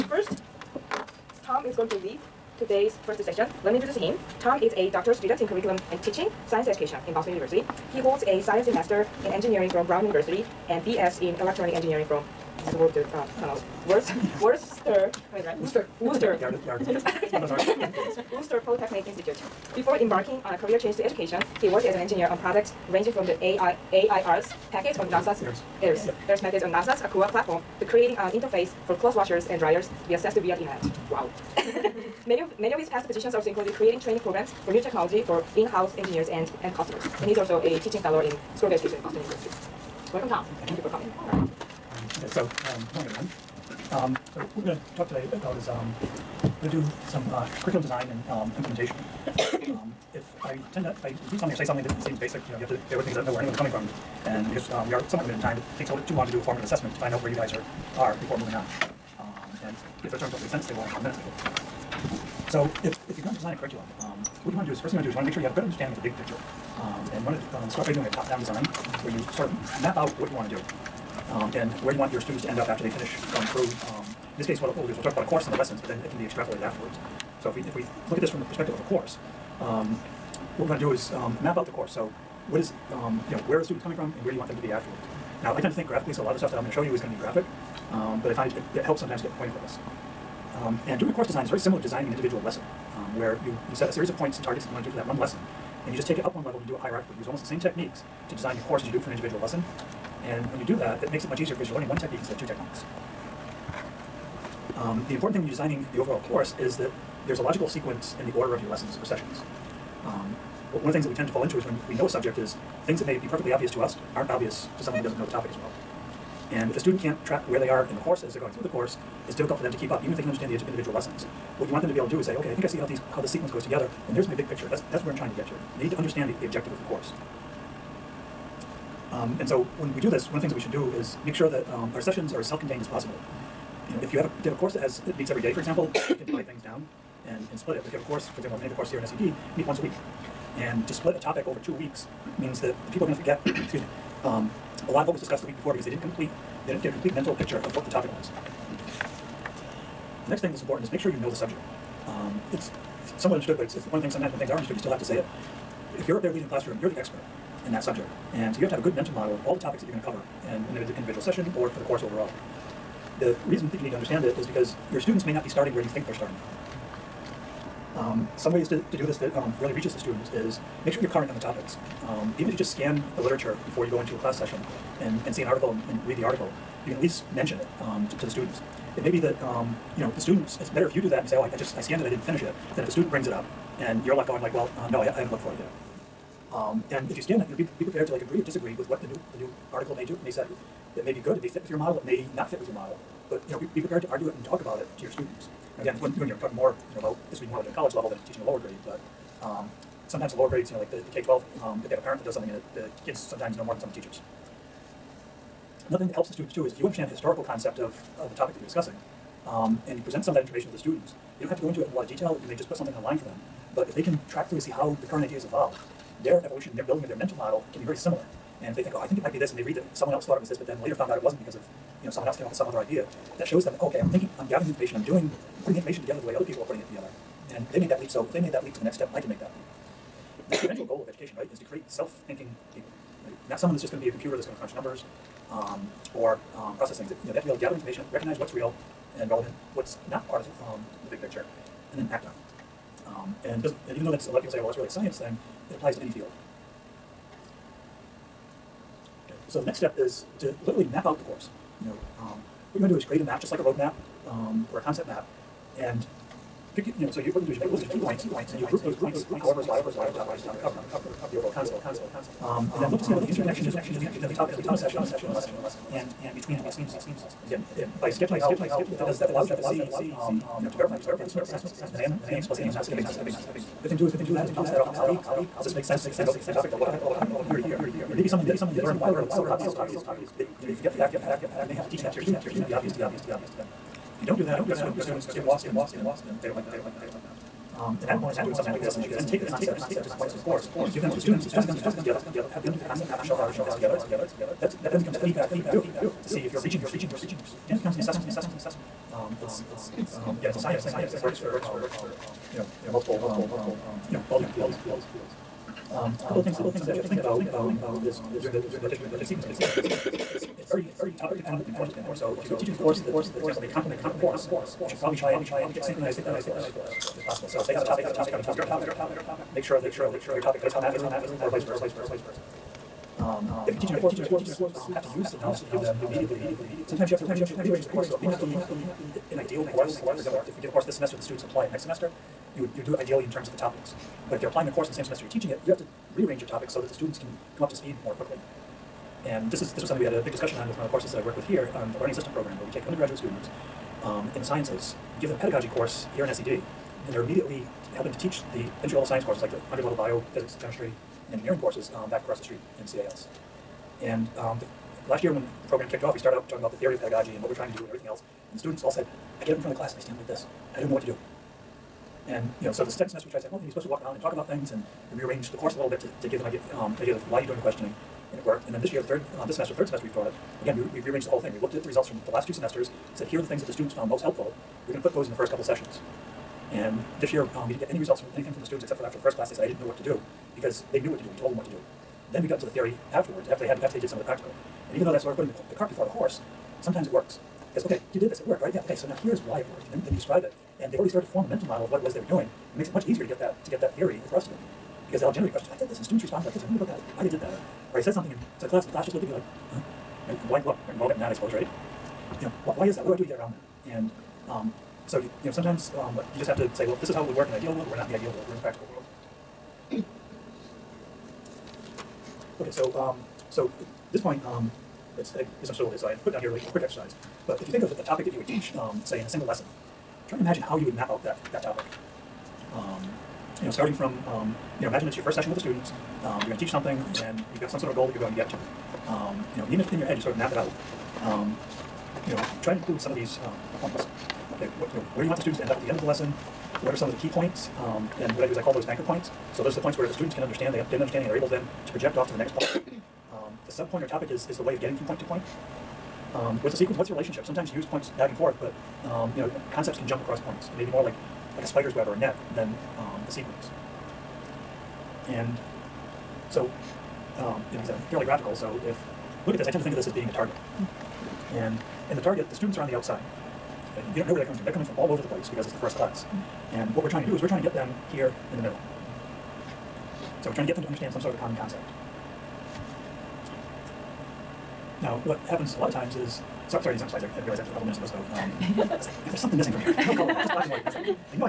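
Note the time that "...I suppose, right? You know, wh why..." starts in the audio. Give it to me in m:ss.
6:41.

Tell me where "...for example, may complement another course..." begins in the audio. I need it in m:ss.
5:13.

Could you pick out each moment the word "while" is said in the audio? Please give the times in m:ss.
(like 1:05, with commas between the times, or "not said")
4:38.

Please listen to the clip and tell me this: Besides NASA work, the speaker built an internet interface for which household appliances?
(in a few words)
clothes washers and dryers.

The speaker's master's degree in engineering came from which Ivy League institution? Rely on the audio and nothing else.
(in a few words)
Brown University.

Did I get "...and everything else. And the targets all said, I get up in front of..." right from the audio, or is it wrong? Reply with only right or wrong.
wrong.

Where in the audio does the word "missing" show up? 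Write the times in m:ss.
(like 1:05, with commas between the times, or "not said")
7:59.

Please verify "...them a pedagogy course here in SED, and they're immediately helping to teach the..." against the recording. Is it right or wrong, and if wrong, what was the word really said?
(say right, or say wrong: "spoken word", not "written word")
right.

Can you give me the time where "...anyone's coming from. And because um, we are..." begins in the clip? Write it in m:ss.
0:53.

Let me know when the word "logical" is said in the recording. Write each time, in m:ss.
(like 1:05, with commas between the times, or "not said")
1:47, 4:19.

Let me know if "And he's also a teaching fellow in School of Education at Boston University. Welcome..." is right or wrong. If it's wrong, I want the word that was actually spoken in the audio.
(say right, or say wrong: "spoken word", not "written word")
right.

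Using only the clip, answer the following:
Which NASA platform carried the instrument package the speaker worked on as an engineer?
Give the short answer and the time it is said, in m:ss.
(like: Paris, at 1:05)
Aqua, at 0:26.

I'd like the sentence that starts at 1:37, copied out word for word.
You use almost the same techniques to design your course as you do it for an individual lesson.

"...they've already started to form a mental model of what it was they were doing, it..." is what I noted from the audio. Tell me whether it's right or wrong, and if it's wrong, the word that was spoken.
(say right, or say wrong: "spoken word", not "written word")
right.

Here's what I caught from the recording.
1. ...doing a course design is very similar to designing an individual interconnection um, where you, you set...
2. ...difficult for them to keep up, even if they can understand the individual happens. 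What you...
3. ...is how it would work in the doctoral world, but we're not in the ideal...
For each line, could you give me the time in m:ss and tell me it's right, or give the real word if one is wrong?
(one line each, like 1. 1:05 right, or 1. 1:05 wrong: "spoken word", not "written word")
1. 1:30 wrong: "lesson", not "interconnection"
2. 1:59 wrong: "lessons", not "happens"
3. 6:47 wrong: "ideal", not "doctoral".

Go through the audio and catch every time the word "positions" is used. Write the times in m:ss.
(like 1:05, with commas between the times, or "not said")
0:33.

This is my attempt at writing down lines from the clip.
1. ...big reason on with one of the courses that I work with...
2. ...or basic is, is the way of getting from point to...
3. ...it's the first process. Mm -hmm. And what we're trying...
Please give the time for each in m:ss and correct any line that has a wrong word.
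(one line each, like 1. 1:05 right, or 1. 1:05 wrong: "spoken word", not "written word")
1. 5:40 wrong: "discussion", not "reason"
2. 7:24 wrong: "topic", not "basic"
3. 7:45 wrong: "class", not "process".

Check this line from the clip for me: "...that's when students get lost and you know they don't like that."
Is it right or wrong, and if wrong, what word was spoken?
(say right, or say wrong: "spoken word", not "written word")
right.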